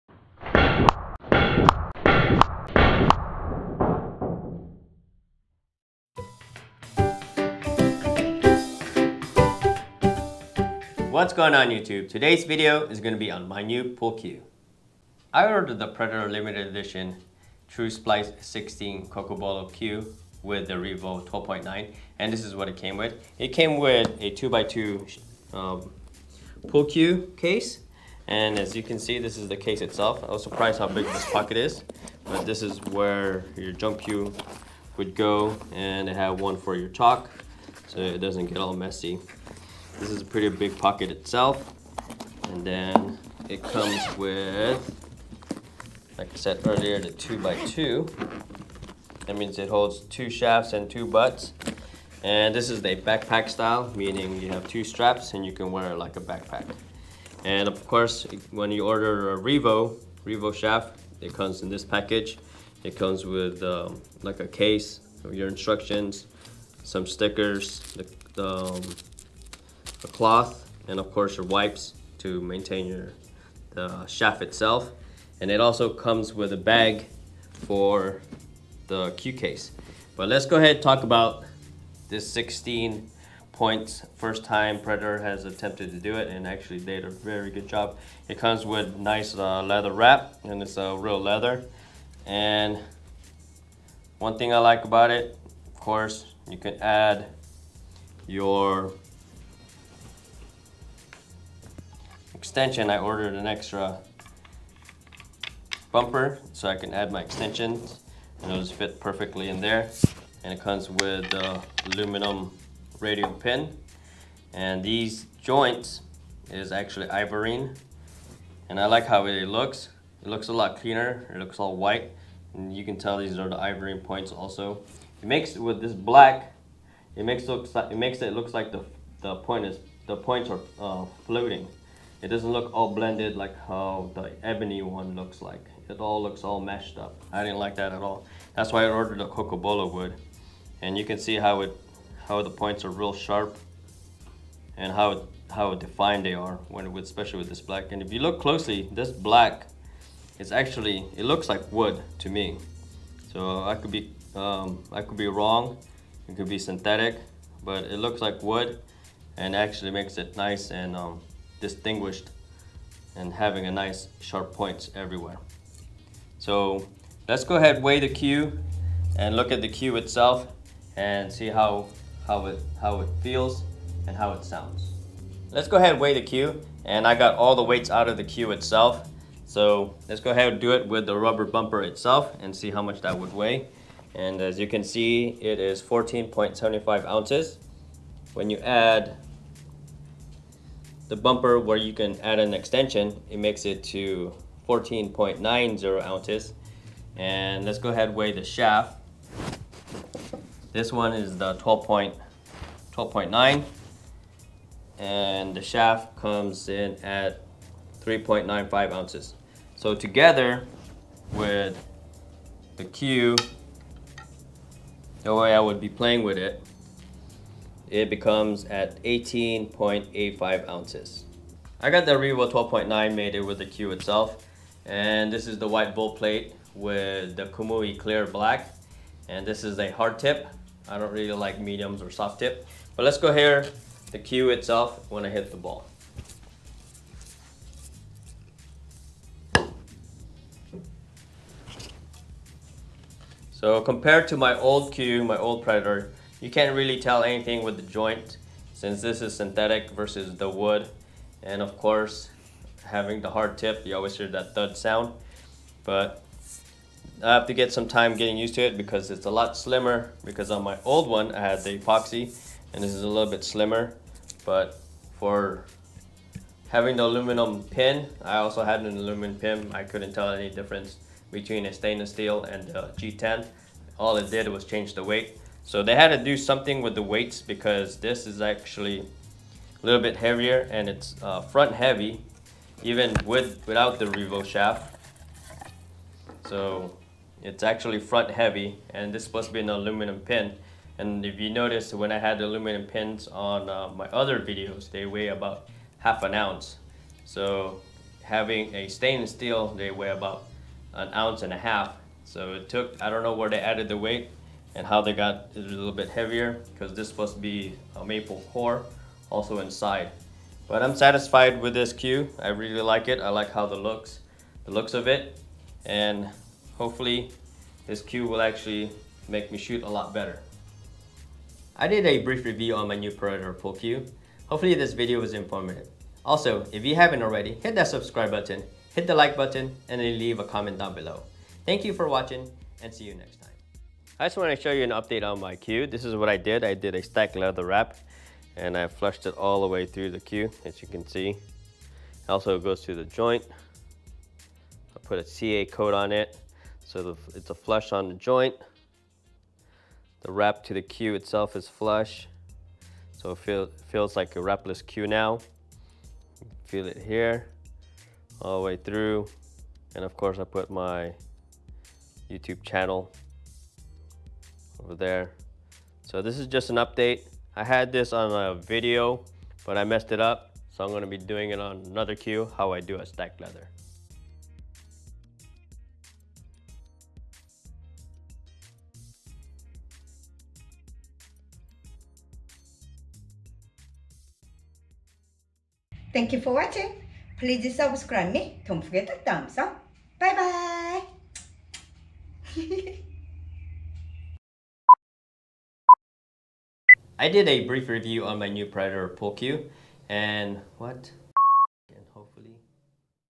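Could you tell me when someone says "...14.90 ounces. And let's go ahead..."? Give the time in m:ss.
3:14.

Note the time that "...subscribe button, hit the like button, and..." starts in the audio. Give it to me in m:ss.
5:27.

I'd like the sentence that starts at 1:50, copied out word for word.
And it comes with the aluminum radial pin.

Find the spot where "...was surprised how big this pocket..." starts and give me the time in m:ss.
0:30.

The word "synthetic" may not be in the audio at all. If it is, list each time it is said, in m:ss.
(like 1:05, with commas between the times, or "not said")
2:36, 4:09.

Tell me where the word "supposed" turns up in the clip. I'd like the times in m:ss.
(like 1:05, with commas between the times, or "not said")
4:49.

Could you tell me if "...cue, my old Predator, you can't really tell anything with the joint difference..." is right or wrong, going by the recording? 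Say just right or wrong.
wrong.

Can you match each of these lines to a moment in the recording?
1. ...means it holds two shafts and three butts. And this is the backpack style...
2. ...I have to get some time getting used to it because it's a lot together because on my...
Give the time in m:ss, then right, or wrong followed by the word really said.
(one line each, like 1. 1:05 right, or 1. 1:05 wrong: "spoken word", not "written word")
1. 0:49 wrong: "two", not "three"
2. 4:17 wrong: "slimmer", not "together".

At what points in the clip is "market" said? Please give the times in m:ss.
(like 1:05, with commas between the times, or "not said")
not said.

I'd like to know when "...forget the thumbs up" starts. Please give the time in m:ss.
6:28.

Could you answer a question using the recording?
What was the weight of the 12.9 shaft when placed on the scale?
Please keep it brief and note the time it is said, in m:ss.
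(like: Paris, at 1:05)
3.95 ounces, at 3:28.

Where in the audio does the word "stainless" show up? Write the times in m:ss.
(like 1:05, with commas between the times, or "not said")
4:31, 4:58.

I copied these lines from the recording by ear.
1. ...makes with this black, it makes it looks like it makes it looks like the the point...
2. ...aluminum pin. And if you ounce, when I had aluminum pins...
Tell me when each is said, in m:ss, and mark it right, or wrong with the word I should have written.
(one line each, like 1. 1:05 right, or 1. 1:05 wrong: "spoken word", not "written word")
1. 2:05 right
2. 4:49 wrong: "notice", not "ounce".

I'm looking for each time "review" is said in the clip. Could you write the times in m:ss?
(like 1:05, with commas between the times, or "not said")
5:22, 6:37.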